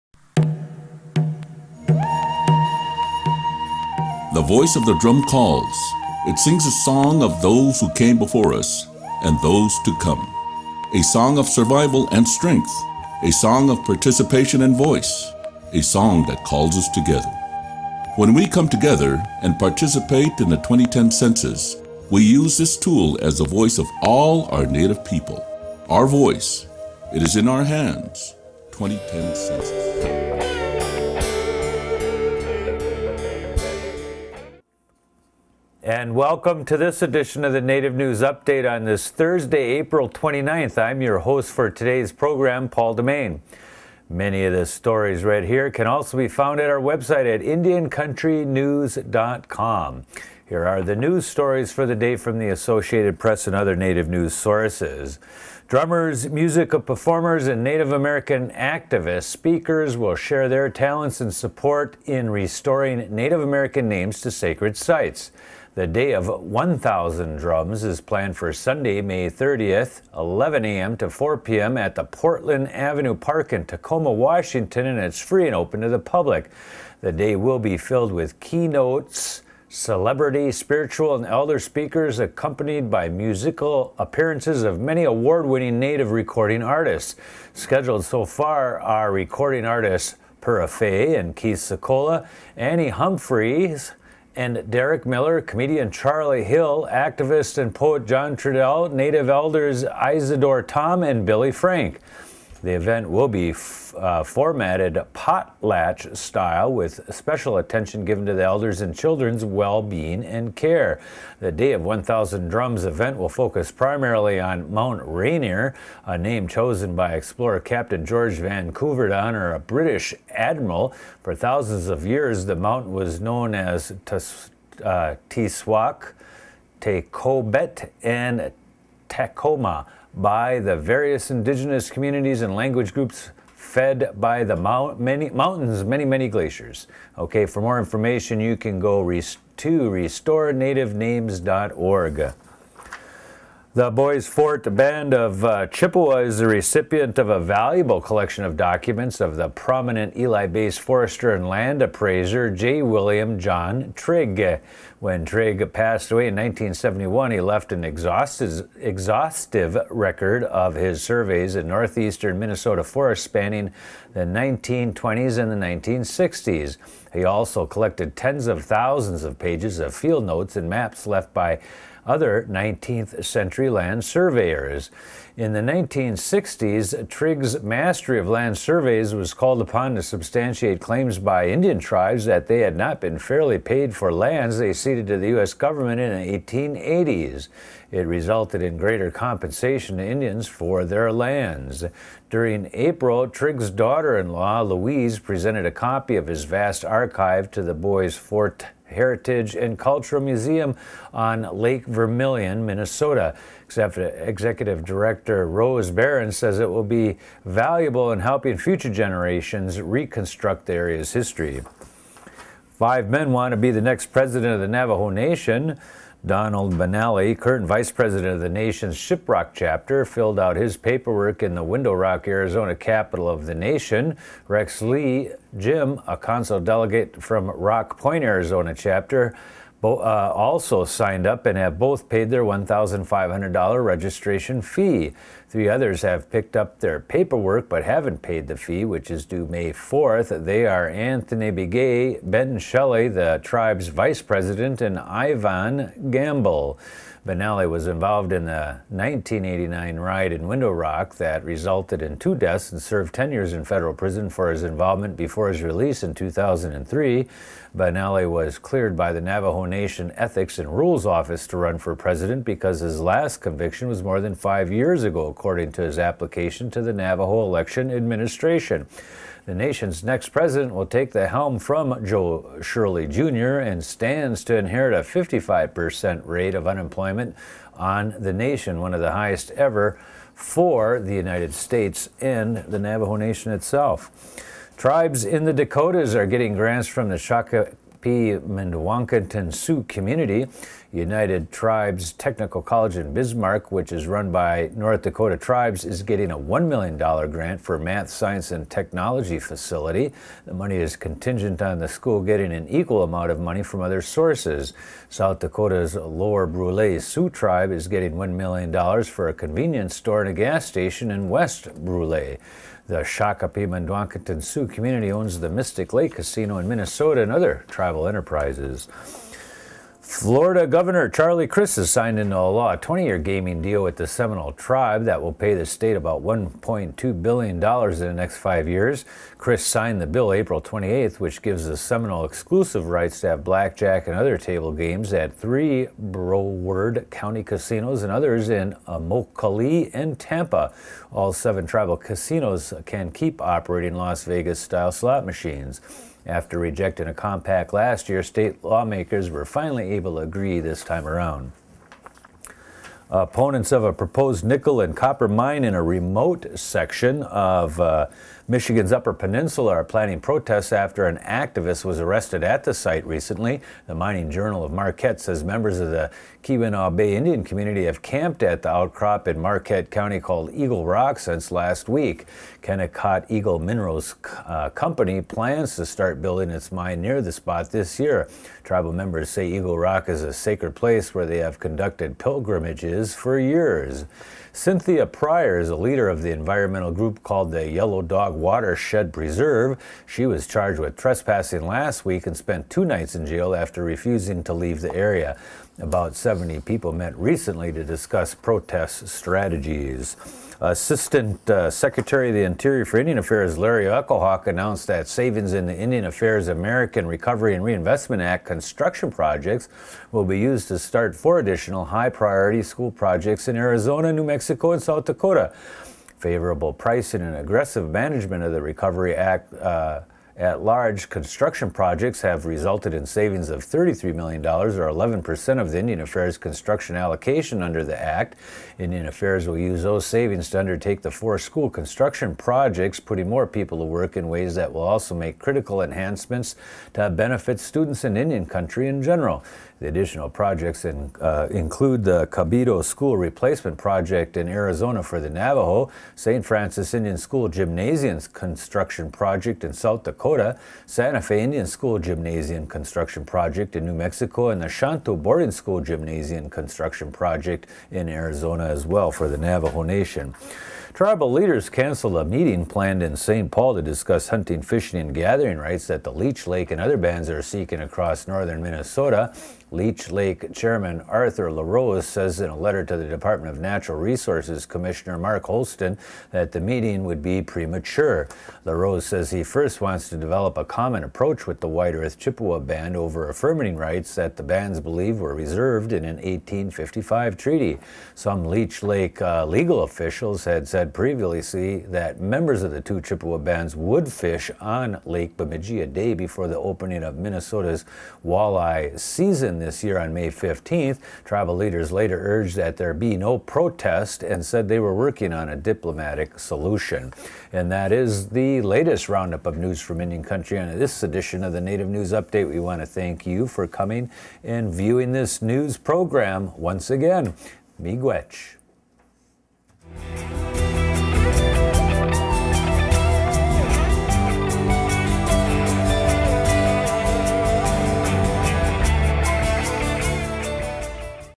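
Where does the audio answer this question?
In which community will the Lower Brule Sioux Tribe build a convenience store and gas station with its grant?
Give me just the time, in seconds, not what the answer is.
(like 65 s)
311 s.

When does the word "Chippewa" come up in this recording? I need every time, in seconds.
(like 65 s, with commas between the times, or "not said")
145 s, 482 s, 492 s.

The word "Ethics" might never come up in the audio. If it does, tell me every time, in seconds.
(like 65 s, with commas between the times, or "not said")
260 s.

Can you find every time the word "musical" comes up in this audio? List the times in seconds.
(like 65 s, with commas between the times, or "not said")
56 s, 83 s.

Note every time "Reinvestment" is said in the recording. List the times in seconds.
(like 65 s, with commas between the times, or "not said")
407 s.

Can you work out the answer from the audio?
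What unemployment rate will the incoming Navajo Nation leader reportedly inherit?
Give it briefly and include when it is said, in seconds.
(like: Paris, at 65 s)
55%, at 274 s.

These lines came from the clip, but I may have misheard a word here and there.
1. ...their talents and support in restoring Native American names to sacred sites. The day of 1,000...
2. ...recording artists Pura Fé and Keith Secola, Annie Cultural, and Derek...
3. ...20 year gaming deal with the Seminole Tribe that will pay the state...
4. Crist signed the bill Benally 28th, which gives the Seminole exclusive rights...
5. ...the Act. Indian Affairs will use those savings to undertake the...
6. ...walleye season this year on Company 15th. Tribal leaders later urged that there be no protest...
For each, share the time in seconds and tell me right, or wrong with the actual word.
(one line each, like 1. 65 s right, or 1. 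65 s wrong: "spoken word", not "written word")
1. 60 s right
2. 89 s wrong: "Humphreys", not "Cultural"
3. 322 s right
4. 329 s wrong: "April", not "Benally"
5. 427 s right
6. 498 s wrong: "May", not "Company".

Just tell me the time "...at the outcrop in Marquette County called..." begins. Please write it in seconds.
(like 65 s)
368 s.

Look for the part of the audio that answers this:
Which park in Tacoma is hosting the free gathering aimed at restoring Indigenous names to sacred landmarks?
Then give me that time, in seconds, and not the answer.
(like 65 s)
72 s.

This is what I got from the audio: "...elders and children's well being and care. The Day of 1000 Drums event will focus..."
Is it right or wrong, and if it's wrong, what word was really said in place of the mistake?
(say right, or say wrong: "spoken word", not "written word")
right.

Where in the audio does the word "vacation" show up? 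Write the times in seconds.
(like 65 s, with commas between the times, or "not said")
not said.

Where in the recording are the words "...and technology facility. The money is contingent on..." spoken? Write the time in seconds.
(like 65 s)
298 s.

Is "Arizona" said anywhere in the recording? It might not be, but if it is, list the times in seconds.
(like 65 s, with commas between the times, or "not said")
222 s, 228 s, 413 s, 444 s, 458 s.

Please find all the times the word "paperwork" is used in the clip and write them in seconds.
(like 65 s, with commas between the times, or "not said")
220 s, 236 s.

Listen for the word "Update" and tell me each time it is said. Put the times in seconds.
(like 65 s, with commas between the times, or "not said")
38 s, 512 s.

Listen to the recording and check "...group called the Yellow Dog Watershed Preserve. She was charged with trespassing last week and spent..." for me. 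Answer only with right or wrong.
right.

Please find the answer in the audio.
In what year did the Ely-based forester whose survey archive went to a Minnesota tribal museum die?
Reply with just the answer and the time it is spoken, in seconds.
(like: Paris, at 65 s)
1971, at 156 s.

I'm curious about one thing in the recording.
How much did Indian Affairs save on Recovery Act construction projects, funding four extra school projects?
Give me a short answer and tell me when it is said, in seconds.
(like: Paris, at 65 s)
$33 million, at 423 s.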